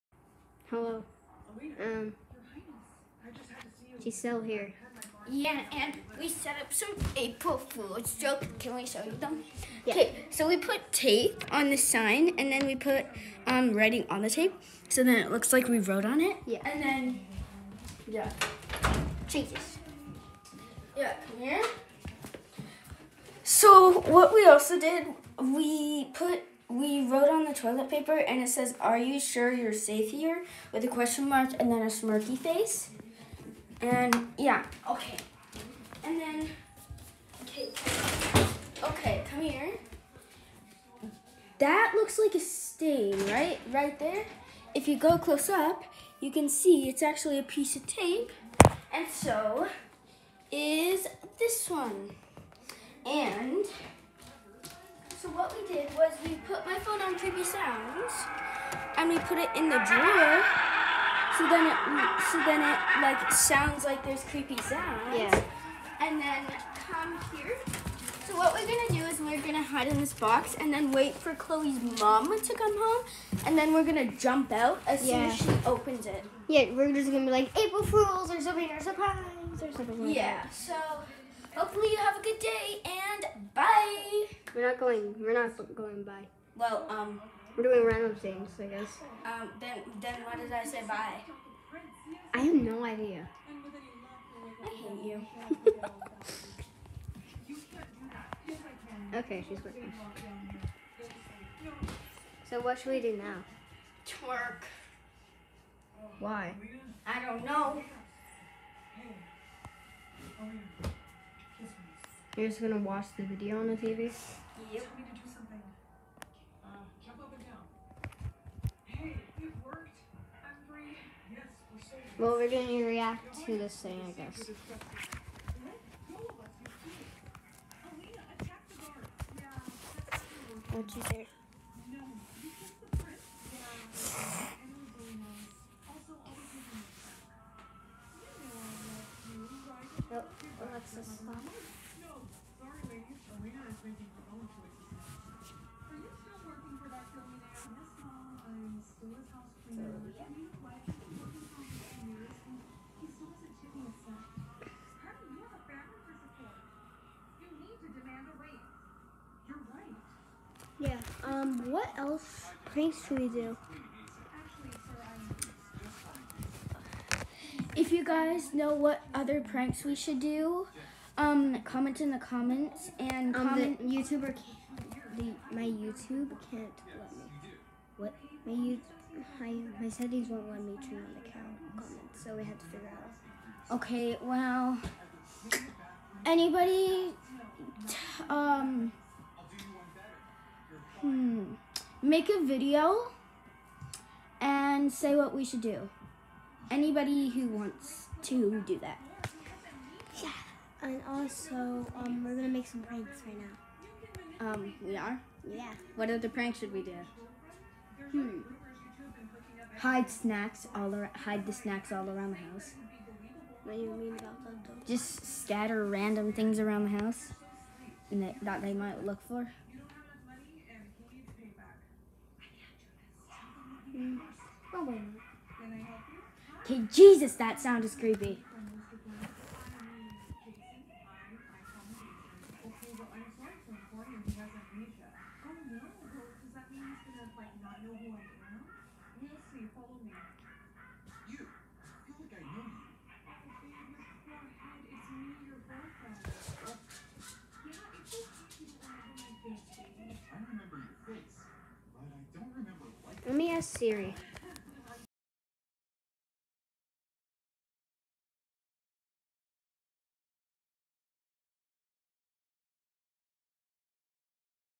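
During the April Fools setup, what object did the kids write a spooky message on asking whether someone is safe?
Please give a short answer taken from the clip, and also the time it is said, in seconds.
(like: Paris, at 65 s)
toilet paper, at 27 s.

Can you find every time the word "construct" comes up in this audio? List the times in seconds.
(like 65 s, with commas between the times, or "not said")
not said.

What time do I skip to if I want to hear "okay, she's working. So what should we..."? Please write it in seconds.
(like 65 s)
99 s.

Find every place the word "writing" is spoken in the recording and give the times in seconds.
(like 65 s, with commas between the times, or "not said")
13 s.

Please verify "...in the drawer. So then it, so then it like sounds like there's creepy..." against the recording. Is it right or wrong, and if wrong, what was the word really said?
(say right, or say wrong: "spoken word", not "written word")
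right.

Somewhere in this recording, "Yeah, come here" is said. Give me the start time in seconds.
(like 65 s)
20 s.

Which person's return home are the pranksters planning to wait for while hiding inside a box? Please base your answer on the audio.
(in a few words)
Chloe's mom.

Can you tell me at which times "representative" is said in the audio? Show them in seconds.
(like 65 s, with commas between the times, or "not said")
not said.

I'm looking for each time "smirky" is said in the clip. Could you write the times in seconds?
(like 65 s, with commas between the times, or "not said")
31 s.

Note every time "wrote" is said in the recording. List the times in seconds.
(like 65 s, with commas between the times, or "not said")
15 s, 27 s.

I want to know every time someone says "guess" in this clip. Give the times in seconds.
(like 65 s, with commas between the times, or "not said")
88 s, 124 s.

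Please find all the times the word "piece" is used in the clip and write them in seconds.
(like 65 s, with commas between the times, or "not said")
47 s.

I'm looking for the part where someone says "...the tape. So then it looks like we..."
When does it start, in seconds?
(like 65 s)
14 s.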